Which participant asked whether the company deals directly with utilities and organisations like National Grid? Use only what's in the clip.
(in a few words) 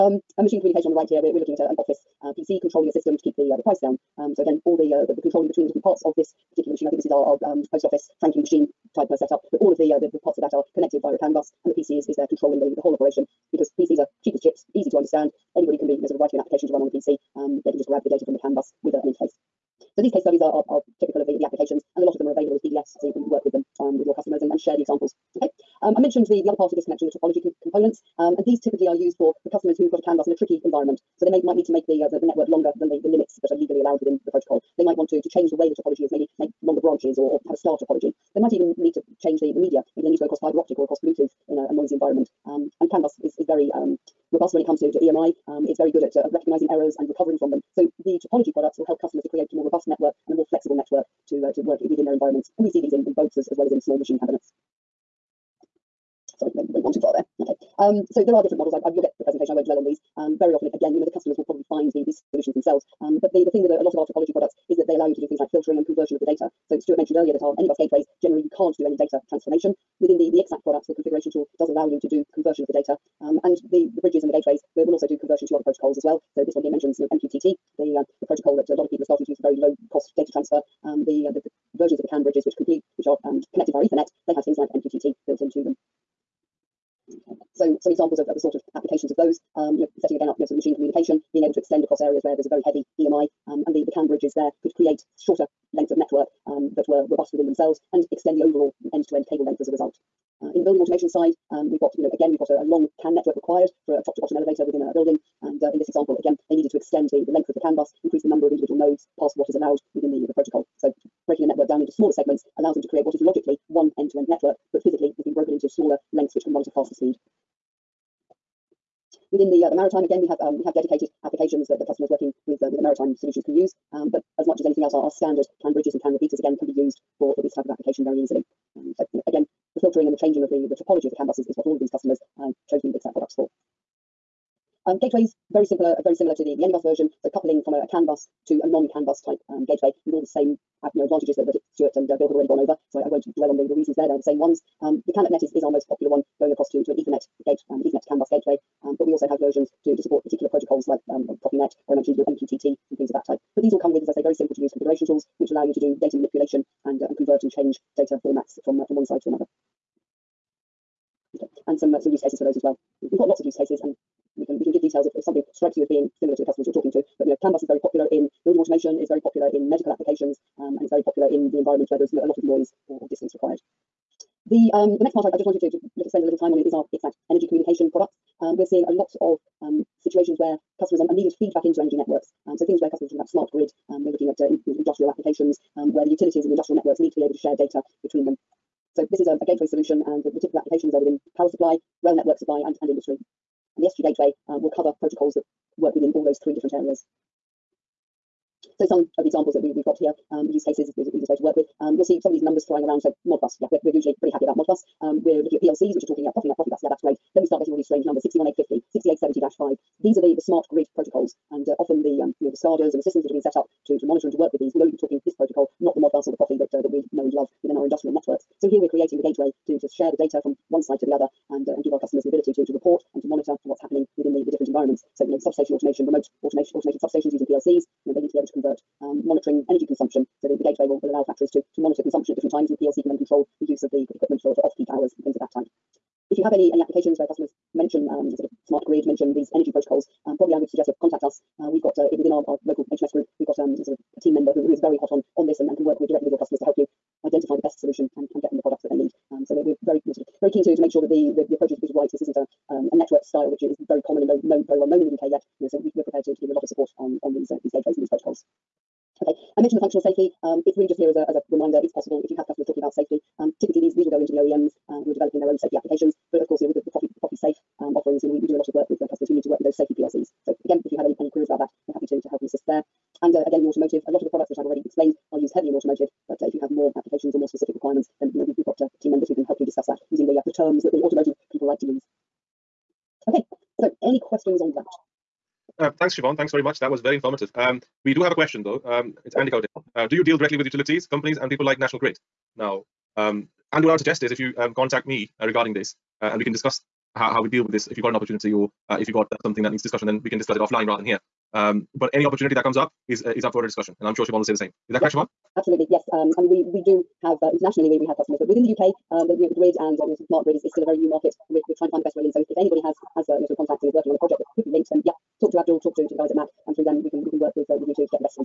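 Andy Cote.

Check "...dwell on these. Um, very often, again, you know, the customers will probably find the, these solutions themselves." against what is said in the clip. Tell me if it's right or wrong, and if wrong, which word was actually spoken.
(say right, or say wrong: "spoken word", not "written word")
right.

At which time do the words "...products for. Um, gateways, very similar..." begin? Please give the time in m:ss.
2:13.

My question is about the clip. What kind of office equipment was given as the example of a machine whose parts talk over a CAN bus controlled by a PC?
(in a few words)
post office franking machine.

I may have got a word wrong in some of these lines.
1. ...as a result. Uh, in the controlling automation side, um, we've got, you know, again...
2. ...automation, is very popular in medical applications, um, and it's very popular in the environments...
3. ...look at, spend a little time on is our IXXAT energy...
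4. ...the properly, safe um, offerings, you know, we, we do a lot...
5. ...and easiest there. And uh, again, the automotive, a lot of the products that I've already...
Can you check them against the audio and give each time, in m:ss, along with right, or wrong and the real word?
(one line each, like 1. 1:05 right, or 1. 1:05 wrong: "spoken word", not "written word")
1. 1:39 wrong: "building", not "controlling"
2. 2:48 right
3. 2:55 right
4. 4:26 right
5. 4:32 wrong: "assist", not "easiest".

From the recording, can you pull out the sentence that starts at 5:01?
Um, but any opportunity that comes up is uh, is up for a discussion, and I'm sure Siobhan will say the same.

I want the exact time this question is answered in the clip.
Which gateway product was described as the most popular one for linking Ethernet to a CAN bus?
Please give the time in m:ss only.
2:25.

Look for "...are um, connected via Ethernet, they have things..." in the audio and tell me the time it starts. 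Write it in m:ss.
1:23.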